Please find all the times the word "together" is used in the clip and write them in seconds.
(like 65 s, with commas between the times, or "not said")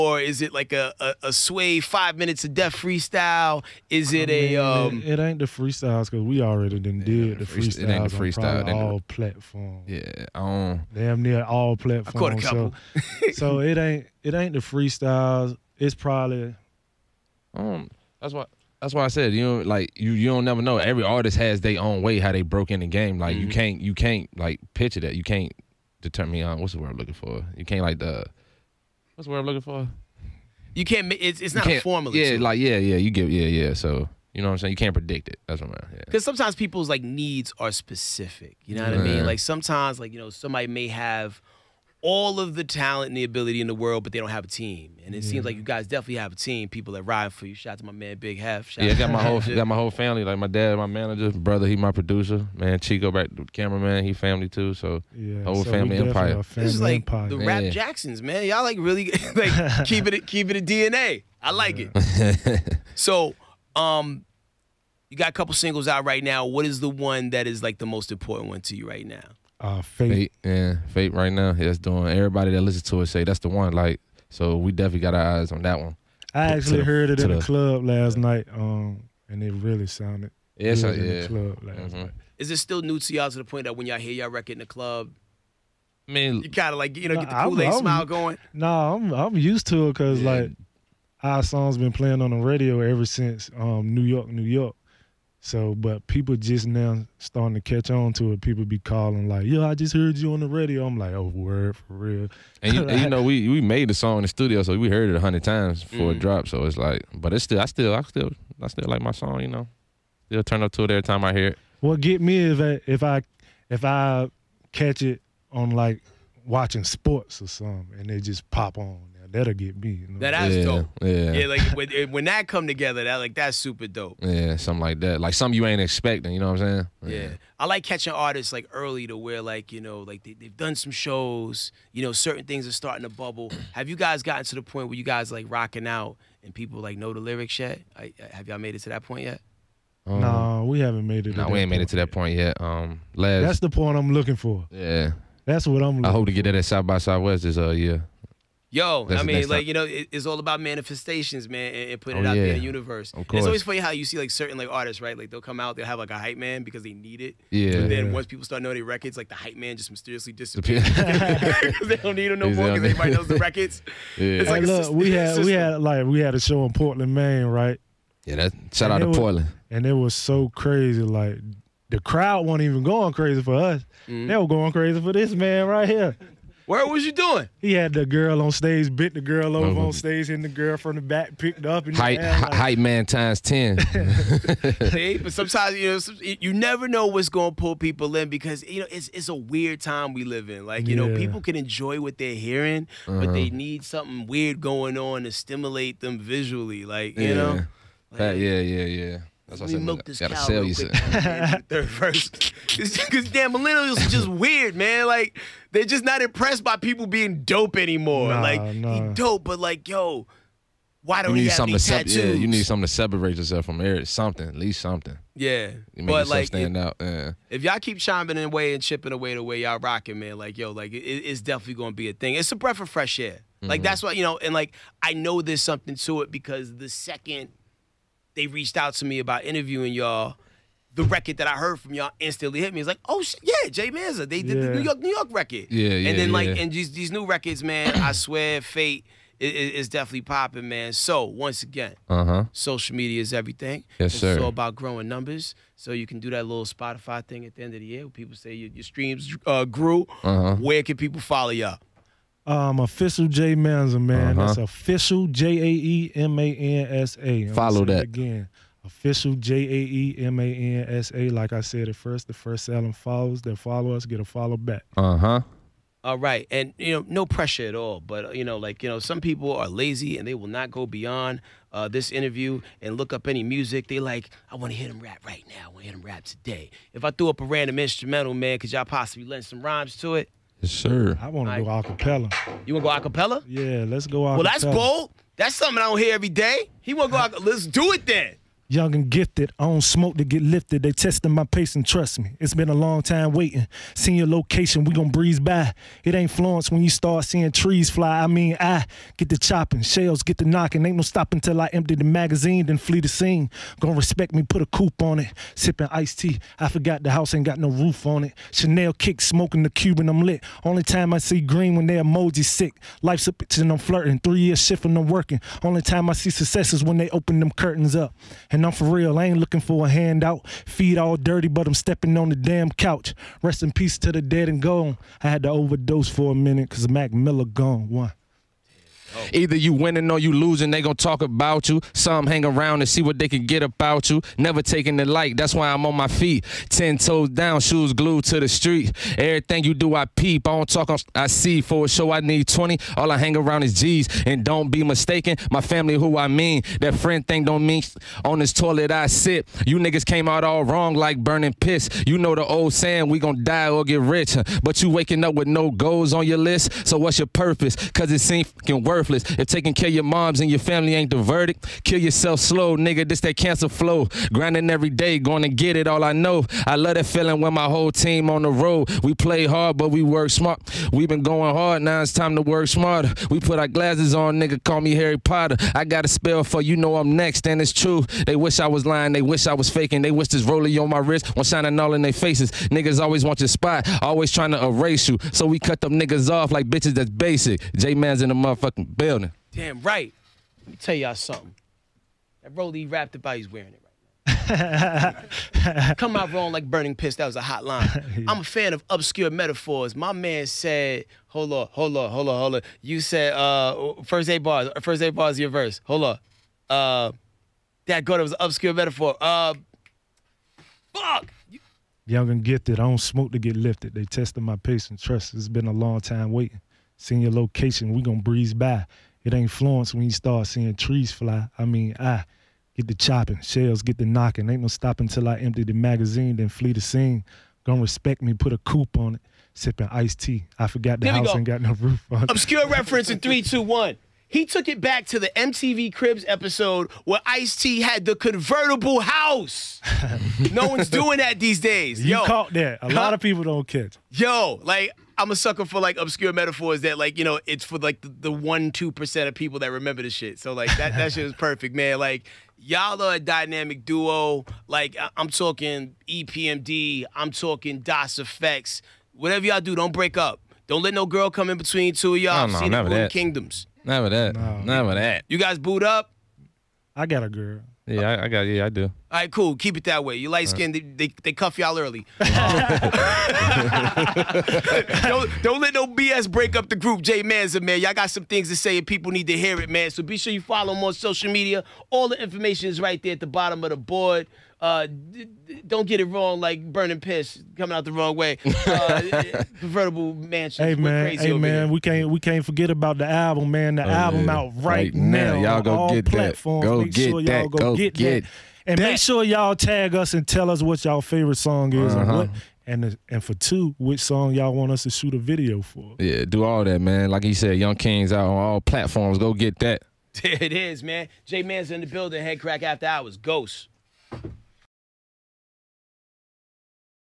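122 s.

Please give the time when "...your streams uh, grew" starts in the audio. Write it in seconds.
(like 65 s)
248 s.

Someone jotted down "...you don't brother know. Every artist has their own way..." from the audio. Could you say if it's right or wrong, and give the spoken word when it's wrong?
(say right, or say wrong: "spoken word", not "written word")
wrong: "never", not "brother".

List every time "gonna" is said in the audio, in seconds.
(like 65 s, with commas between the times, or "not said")
221 s, 303 s, 330 s, 353 s, 418 s, 427 s.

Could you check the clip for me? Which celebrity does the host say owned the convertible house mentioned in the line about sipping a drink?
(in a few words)
Ice T.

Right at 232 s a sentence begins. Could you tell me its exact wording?
It's like, oh shit, yeah, Jae Mansa.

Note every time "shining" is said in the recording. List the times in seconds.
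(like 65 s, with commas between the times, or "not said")
381 s.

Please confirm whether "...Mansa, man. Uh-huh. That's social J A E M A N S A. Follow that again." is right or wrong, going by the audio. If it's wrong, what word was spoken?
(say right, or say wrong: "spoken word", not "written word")
wrong: "official", not "social".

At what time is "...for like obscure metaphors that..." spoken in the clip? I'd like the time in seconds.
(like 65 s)
445 s.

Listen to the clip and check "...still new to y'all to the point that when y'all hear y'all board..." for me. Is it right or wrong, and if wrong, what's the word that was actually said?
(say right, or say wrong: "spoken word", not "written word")
wrong: "record", not "board".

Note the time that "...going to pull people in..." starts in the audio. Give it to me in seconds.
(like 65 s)
187 s.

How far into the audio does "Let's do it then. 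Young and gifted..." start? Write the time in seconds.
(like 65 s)
287 s.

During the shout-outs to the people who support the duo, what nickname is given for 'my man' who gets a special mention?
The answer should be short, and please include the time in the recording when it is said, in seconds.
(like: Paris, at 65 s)
Big Hef, at 48 s.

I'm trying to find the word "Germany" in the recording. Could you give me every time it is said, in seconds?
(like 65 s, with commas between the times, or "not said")
not said.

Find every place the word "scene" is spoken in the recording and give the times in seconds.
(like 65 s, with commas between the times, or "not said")
303 s, 426 s.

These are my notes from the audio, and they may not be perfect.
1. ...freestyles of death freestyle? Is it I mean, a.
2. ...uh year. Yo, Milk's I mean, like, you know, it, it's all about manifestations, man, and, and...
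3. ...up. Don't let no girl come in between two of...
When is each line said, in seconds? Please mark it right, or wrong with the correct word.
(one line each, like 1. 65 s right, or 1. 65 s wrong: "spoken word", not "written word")
1. 2 s wrong: "minutes", not "freestyles"
2. 147 s wrong: "That", not "Milk"
3. 460 s right.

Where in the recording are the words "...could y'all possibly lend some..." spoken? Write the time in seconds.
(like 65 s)
278 s.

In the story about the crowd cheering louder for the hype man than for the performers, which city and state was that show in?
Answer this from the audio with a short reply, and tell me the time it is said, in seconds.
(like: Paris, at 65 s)
Portland, Maine, at 166 s.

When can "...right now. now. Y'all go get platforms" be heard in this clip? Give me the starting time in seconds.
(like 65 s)
494 s.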